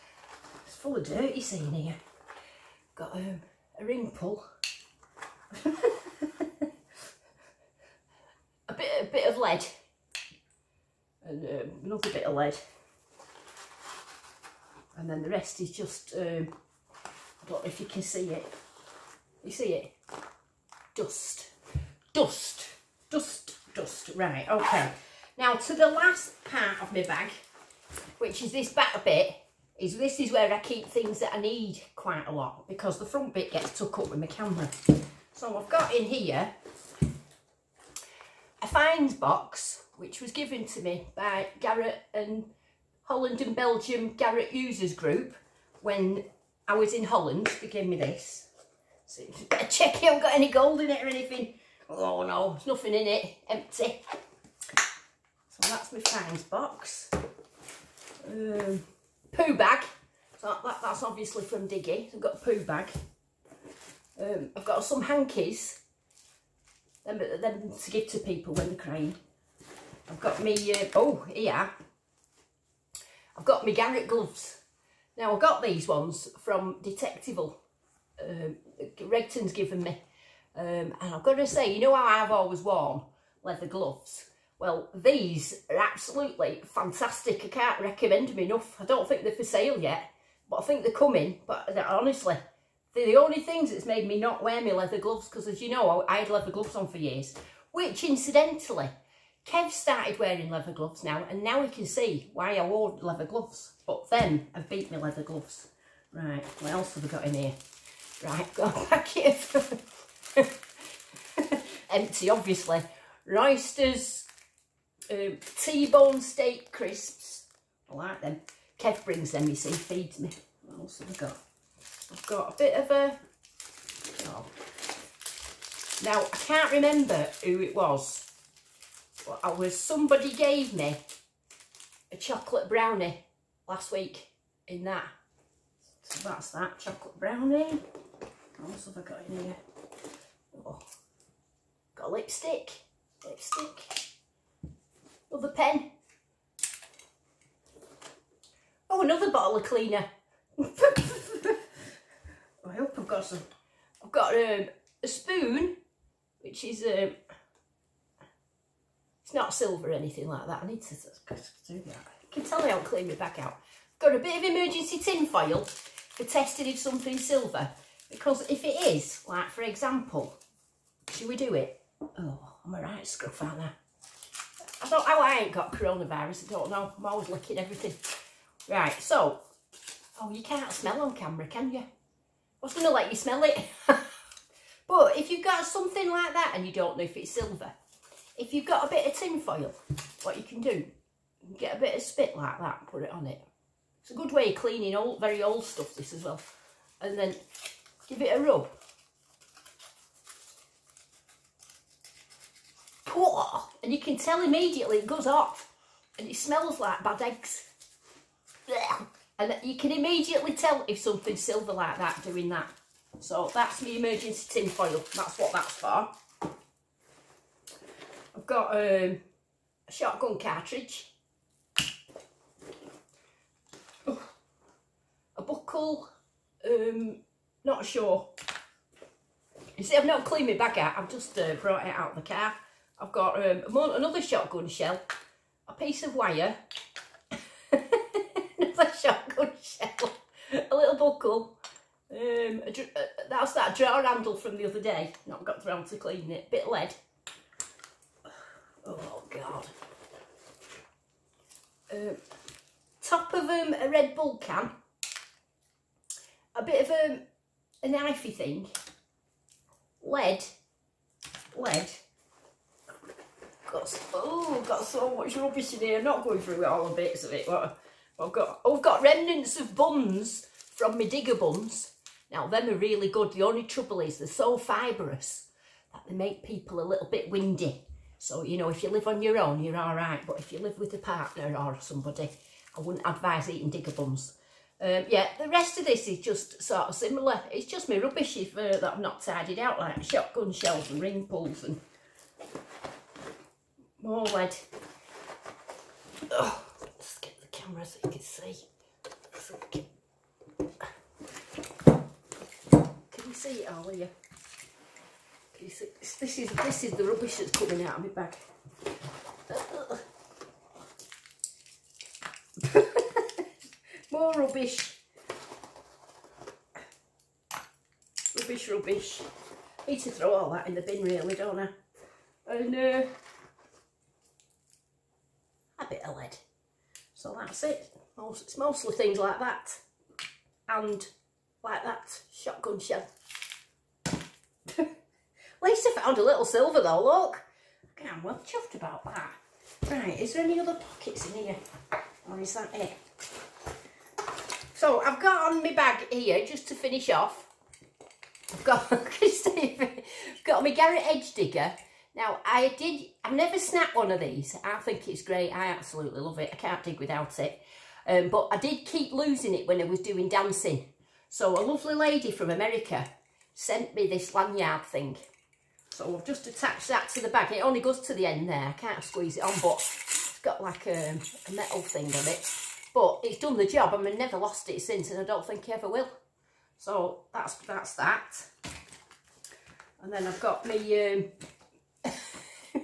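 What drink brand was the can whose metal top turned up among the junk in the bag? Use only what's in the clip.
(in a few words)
Red Bull.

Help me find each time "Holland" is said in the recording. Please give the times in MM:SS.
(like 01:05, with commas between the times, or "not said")
00:43, 00:47.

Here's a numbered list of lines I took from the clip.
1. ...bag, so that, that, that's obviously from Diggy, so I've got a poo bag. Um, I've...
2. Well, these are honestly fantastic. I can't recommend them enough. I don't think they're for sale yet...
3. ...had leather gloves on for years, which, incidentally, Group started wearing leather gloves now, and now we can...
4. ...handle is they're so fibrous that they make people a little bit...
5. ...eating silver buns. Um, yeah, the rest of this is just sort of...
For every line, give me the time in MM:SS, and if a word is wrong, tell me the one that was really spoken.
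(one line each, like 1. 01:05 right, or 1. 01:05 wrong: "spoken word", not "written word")
1. 00:59 right
2. 01:24 wrong: "absolutely", not "honestly"
3. 01:36 wrong: "Kev", not "Group"
4. 04:33 wrong: "trouble", not "handle"
5. 04:43 wrong: "digger", not "silver".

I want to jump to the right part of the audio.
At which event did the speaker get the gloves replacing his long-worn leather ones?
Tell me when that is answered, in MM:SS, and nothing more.
01:16.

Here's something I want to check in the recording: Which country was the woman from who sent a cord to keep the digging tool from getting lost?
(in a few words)
America.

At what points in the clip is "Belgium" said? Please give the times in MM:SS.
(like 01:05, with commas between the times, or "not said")
00:43.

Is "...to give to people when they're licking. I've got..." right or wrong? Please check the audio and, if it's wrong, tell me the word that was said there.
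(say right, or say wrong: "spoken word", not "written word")
wrong: "crying", not "licking".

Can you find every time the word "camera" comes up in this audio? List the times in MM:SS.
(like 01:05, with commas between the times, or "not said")
00:34, 03:01, 04:57.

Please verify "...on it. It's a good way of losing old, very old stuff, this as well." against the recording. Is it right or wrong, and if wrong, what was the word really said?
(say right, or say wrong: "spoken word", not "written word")
wrong: "cleaning", not "losing".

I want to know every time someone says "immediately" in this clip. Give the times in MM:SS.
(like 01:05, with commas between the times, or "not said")
03:24, 03:29.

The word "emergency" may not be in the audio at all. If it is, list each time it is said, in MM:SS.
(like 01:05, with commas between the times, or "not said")
02:44, 03:33.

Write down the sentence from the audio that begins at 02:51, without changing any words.
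Oh, I'm all right, Scruff, aren't I?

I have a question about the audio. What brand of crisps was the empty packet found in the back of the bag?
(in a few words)
Roysters.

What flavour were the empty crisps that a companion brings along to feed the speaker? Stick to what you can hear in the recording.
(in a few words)
T-bone steak.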